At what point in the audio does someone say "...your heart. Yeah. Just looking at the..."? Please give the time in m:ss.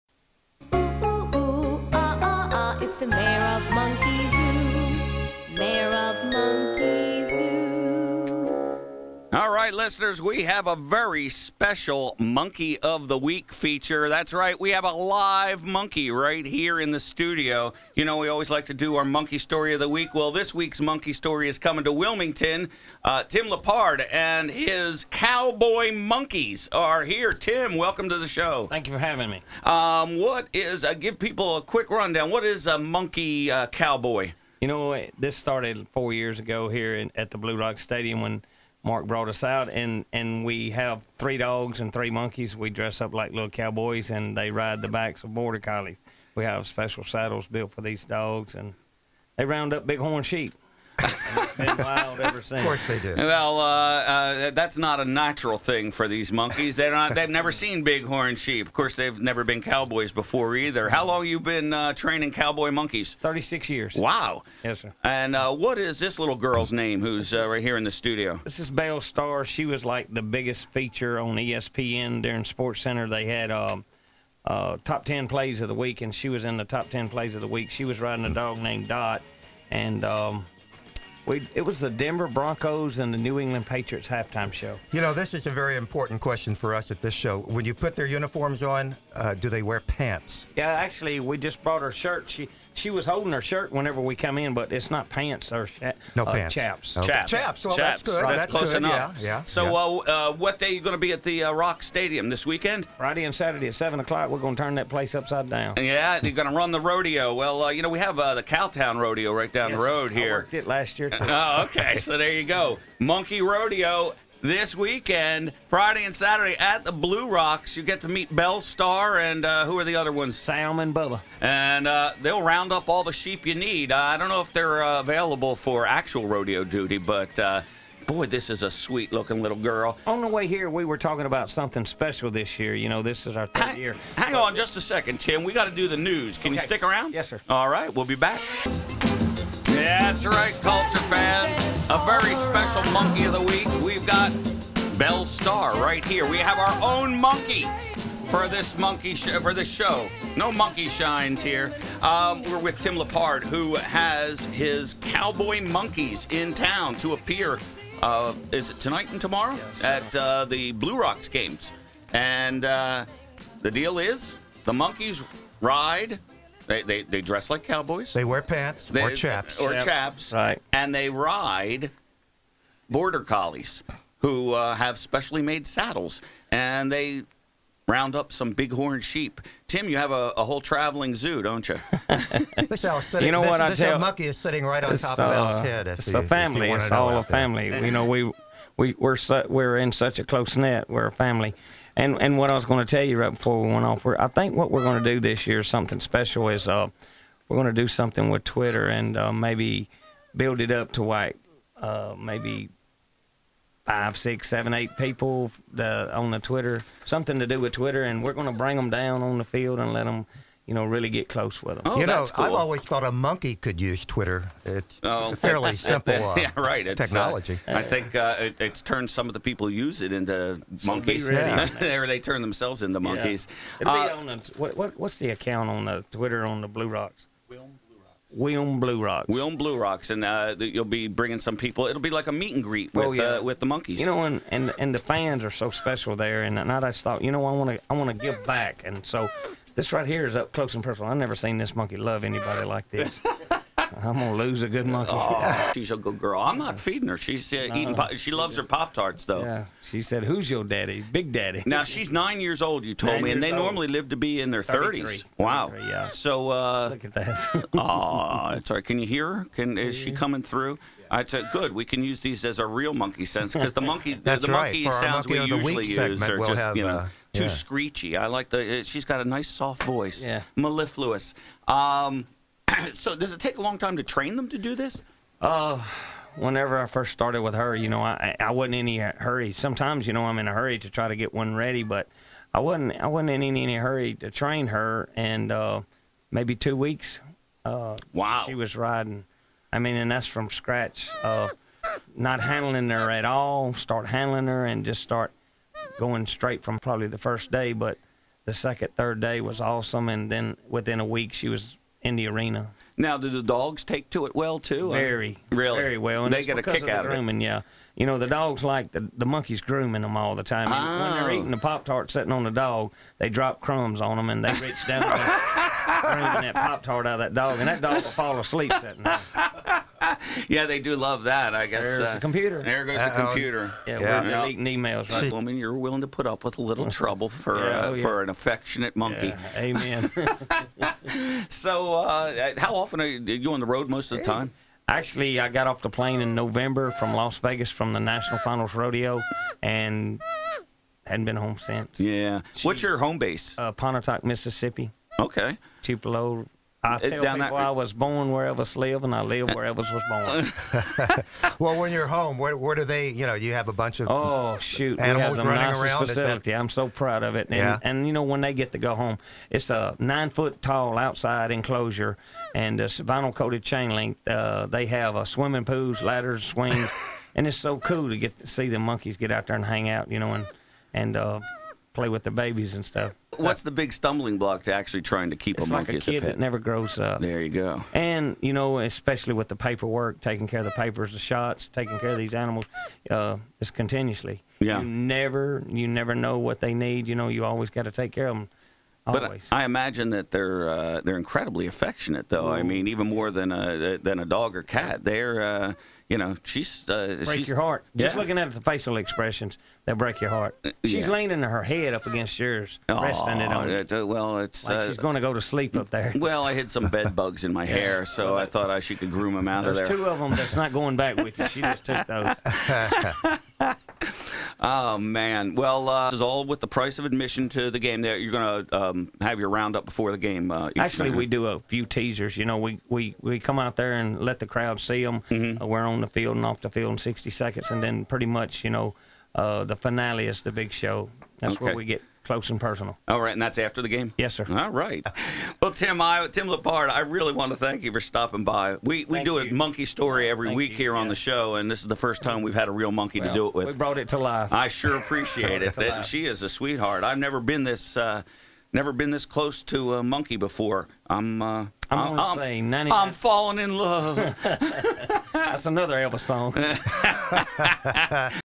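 6:37.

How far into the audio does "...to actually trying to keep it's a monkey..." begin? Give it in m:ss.
6:14.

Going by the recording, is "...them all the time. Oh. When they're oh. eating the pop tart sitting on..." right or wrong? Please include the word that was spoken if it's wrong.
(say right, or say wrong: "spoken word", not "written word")
right.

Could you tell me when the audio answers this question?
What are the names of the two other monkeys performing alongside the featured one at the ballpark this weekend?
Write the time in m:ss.
2:00.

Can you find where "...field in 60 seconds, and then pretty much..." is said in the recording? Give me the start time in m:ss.
7:06.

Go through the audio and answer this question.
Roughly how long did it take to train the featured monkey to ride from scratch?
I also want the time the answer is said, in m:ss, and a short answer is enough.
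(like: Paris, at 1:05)
2 weeks, at 4:46.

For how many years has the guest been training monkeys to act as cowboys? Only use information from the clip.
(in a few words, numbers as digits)
36.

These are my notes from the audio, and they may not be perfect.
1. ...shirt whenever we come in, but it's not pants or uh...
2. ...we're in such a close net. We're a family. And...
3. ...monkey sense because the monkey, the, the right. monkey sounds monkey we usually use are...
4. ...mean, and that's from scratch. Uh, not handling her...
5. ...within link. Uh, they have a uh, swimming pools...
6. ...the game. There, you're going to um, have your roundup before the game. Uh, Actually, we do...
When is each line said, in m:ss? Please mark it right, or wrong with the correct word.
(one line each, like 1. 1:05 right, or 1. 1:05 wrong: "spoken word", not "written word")
1. 1:33 right
2. 3:09 right
3. 4:22 right
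4. 4:49 right
5. 6:03 wrong: "chain", not "within"
6. 6:57 right.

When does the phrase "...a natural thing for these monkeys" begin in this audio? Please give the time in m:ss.
0:54.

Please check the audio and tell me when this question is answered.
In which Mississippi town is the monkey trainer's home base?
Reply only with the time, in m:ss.
5:43.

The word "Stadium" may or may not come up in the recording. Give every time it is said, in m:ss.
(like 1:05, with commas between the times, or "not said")
0:37, 1:41.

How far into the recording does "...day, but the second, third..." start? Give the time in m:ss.
4:57.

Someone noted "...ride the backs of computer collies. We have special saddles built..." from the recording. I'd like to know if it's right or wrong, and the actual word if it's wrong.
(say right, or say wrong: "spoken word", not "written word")
wrong: "border", not "computer".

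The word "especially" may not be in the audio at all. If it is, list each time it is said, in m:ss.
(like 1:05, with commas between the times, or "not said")
6:18.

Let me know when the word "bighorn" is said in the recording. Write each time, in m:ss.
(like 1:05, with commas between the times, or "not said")
0:57, 2:58.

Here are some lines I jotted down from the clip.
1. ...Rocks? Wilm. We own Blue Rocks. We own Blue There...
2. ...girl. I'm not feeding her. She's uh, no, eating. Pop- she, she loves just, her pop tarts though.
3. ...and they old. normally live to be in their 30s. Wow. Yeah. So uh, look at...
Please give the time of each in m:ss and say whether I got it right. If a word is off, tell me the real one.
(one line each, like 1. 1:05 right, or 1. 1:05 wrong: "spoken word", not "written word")
1. 3:46 wrong: "Rocks", not "There"
2. 4:06 right
3. 4:13 right.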